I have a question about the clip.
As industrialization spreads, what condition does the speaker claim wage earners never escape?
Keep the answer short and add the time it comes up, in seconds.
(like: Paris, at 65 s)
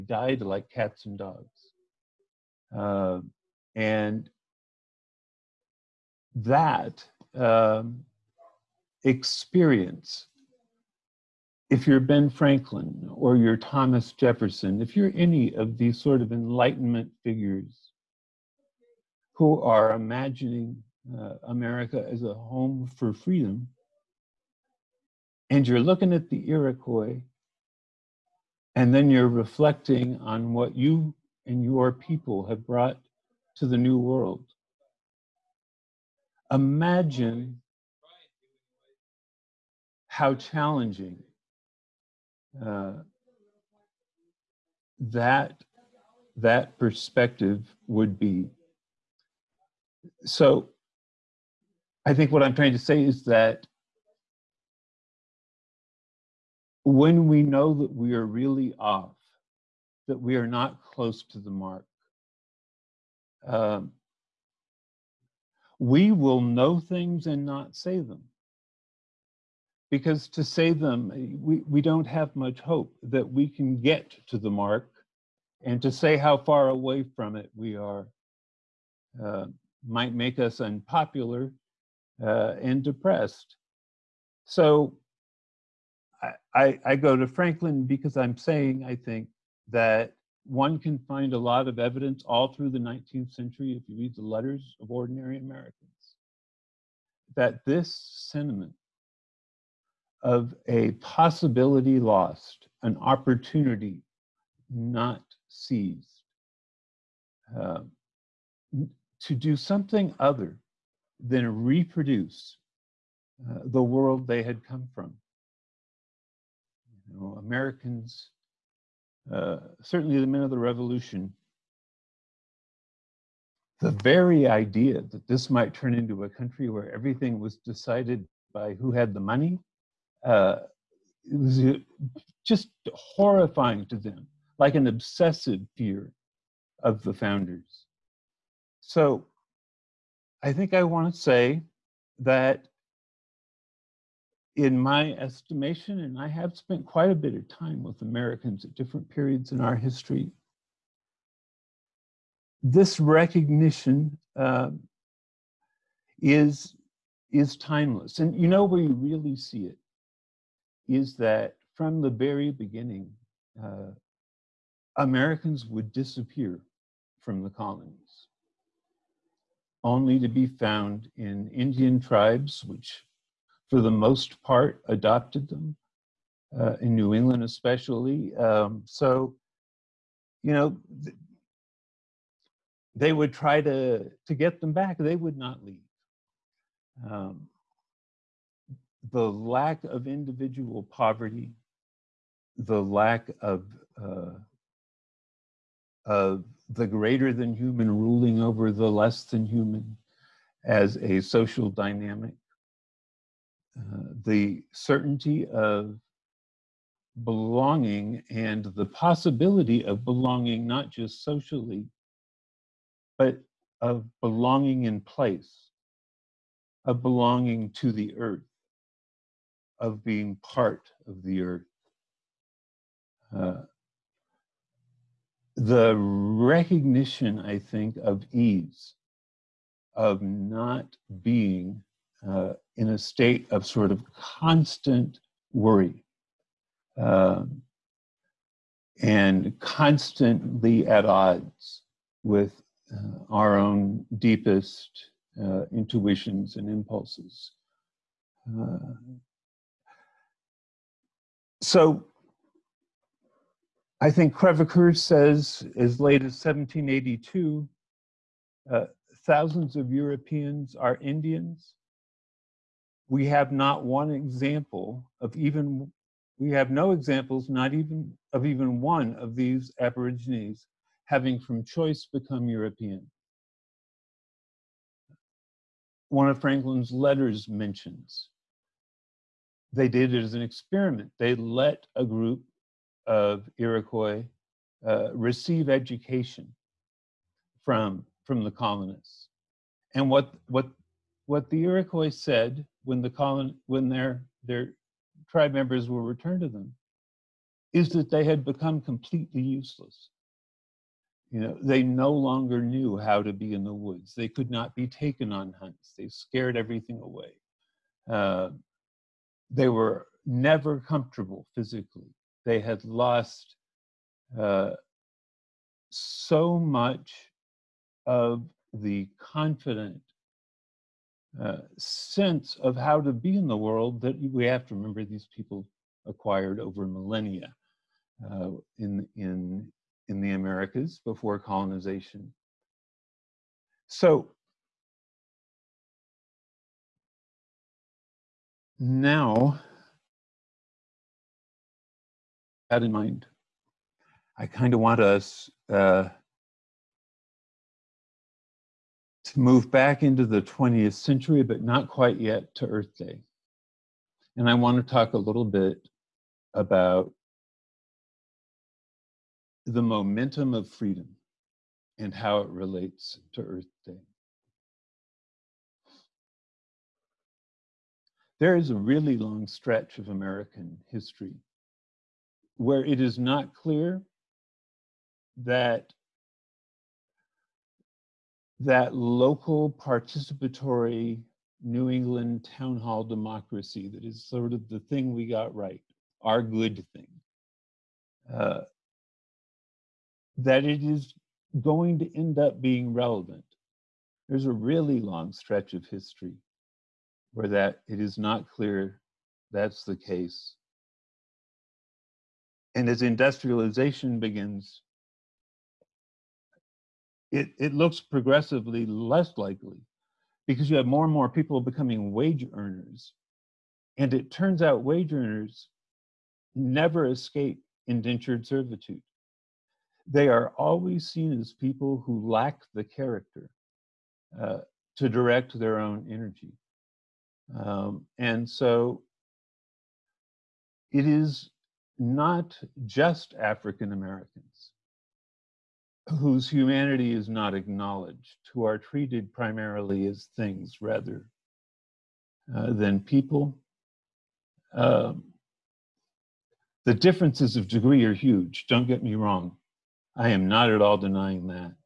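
indentured servitude, at 417 s.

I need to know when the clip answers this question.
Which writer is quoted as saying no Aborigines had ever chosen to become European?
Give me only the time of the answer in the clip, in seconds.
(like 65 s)
254 s.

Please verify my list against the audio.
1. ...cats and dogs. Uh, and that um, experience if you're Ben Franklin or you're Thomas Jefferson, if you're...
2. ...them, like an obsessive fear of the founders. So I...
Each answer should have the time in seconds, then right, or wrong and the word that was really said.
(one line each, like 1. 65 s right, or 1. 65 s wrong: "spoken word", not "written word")
1. 0 s right
2. 133 s right.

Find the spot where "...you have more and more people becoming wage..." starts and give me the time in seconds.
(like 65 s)
410 s.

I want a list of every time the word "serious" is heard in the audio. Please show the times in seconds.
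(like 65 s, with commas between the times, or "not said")
not said.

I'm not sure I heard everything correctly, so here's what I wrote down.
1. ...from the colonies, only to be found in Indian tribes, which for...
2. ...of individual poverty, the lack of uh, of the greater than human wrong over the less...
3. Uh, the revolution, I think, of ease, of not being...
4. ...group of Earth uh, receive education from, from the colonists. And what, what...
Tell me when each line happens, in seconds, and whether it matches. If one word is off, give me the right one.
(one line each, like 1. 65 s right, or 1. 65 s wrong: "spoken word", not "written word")
1. 167 s right
2. 189 s wrong: "ruling", not "wrong"
3. 223 s wrong: "recognition", not "revolution"
4. 282 s wrong: "Iroquois", not "Earth".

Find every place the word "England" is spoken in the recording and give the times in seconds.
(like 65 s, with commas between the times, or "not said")
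177 s, 381 s.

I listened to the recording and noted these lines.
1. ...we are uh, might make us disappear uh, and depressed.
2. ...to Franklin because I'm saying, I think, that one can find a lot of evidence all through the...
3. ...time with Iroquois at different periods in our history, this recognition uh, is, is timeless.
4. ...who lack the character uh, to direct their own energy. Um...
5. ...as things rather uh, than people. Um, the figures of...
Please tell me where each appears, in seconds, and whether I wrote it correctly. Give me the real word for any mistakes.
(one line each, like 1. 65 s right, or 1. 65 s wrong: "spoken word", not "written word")
1. 77 s wrong: "unpopular", not "disappear"
2. 87 s right
3. 147 s wrong: "Americans", not "Iroquois"
4. 422 s right
5. 440 s wrong: "differences", not "figures".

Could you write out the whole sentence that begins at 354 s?
And I want to talk a little bit about the momentum of freedom and how it relates to Earth Day.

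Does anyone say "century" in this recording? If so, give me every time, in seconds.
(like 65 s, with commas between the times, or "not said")
93 s, 350 s.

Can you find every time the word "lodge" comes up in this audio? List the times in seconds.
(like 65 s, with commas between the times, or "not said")
not said.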